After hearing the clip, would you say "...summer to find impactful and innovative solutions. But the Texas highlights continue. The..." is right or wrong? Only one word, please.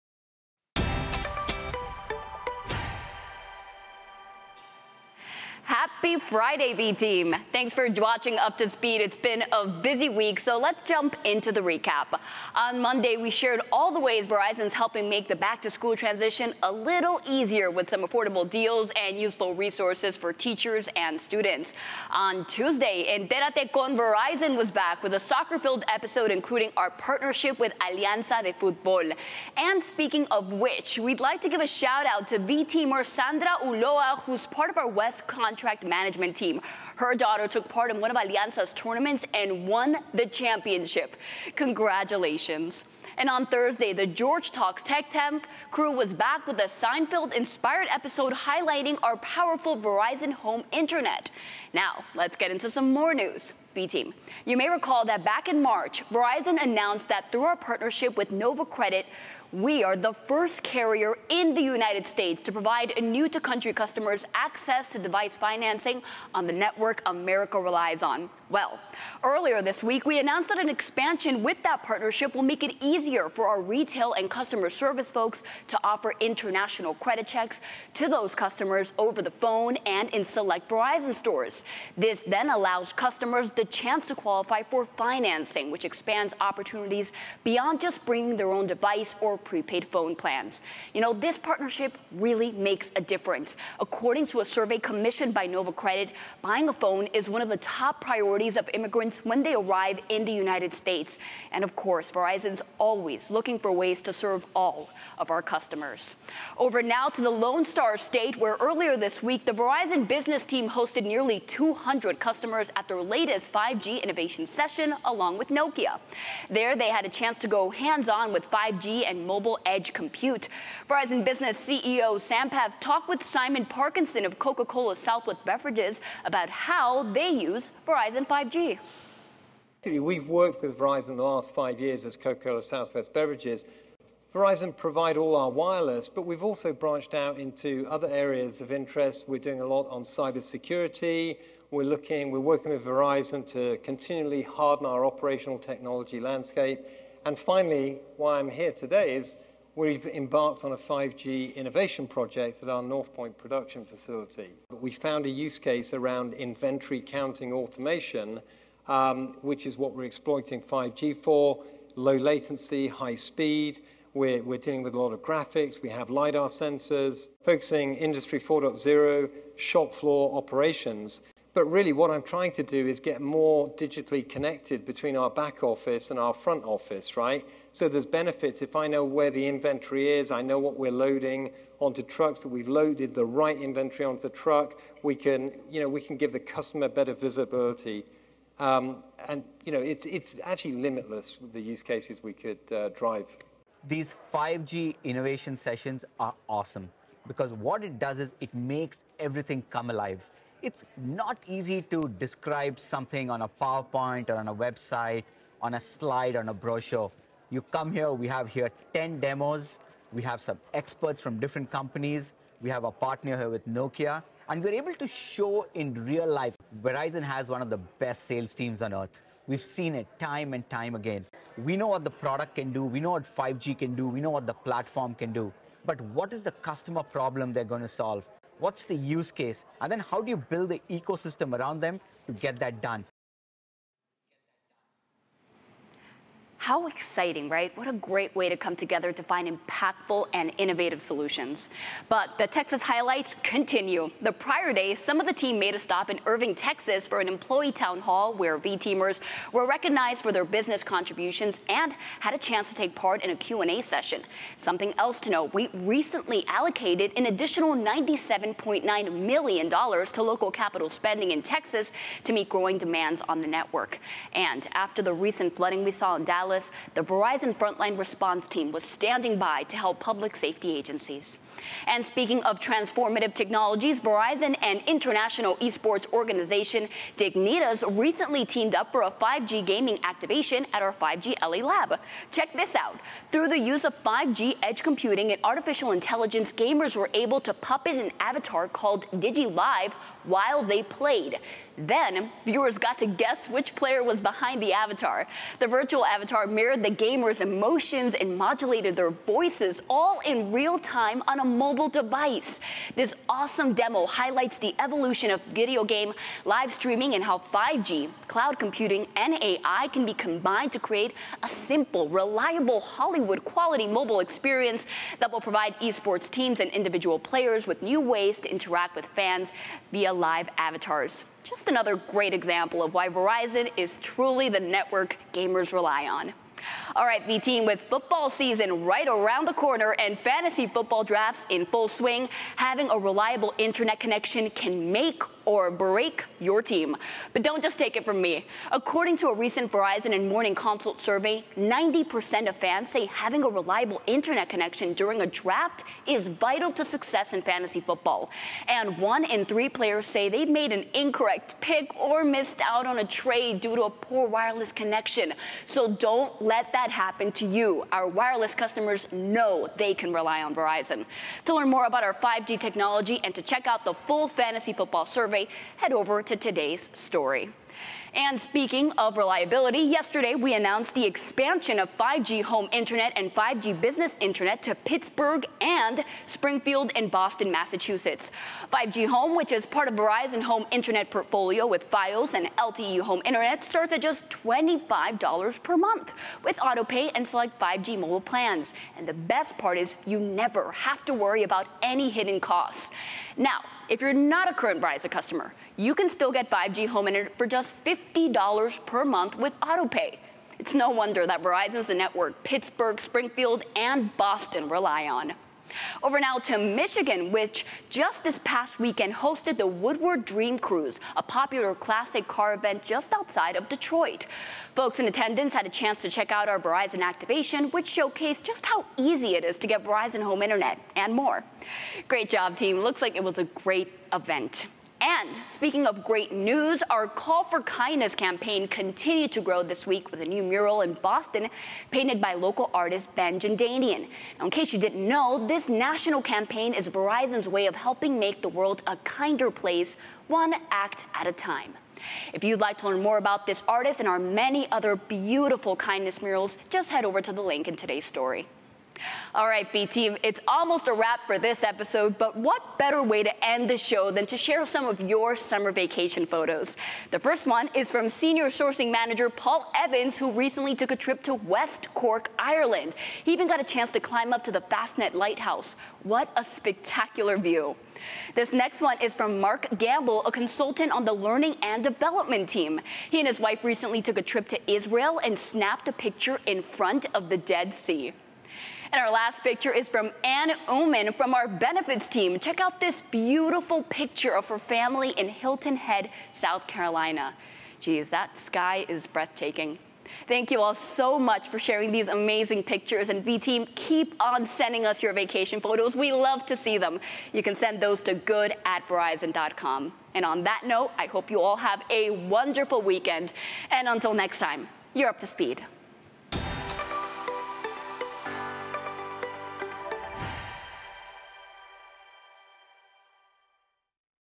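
wrong.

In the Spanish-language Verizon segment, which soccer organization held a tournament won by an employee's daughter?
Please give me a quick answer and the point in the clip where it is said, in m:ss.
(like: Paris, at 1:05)
Alianza de Fútbol, at 0:27.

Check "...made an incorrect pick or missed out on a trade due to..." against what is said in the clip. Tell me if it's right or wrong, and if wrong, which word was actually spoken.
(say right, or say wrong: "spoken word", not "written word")
right.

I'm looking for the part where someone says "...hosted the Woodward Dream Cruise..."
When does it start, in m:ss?
6:49.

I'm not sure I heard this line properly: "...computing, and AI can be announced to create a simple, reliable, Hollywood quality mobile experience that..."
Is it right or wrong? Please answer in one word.
wrong.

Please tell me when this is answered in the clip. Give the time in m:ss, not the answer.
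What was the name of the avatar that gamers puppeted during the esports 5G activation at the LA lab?
4:49.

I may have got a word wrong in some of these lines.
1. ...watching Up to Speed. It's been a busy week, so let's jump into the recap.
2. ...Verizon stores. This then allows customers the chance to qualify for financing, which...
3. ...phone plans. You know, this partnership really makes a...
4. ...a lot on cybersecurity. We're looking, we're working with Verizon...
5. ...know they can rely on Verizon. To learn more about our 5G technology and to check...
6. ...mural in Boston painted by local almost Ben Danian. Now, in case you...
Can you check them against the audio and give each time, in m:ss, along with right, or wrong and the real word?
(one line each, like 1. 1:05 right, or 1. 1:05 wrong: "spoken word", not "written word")
1. 0:07 right
2. 1:20 right
3. 1:29 right
4. 2:19 right
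5. 5:59 right
6. 7:10 wrong: "artist", not "almost".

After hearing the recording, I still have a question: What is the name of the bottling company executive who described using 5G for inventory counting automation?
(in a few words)
Simon Parkinson.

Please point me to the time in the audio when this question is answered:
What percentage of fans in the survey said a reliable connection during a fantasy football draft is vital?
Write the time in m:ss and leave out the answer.
5:41.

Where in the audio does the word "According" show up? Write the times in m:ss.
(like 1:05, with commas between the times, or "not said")
1:33, 5:38.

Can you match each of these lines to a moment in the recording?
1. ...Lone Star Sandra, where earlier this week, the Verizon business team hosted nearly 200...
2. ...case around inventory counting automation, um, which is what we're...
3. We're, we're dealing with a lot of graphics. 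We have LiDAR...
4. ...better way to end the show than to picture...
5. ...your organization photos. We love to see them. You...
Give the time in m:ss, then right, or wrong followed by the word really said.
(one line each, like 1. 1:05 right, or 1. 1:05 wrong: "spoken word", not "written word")
1. 1:47 wrong: "State", not "Sandra"
2. 2:35 right
3. 2:44 right
4. 7:32 wrong: "share", not "picture"
5. 8:15 wrong: "vacation", not "organization".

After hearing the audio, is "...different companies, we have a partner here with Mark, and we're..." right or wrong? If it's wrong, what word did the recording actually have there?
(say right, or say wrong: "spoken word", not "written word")
wrong: "Nokia", not "Mark".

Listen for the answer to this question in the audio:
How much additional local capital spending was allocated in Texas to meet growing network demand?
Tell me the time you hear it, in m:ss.
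4:17.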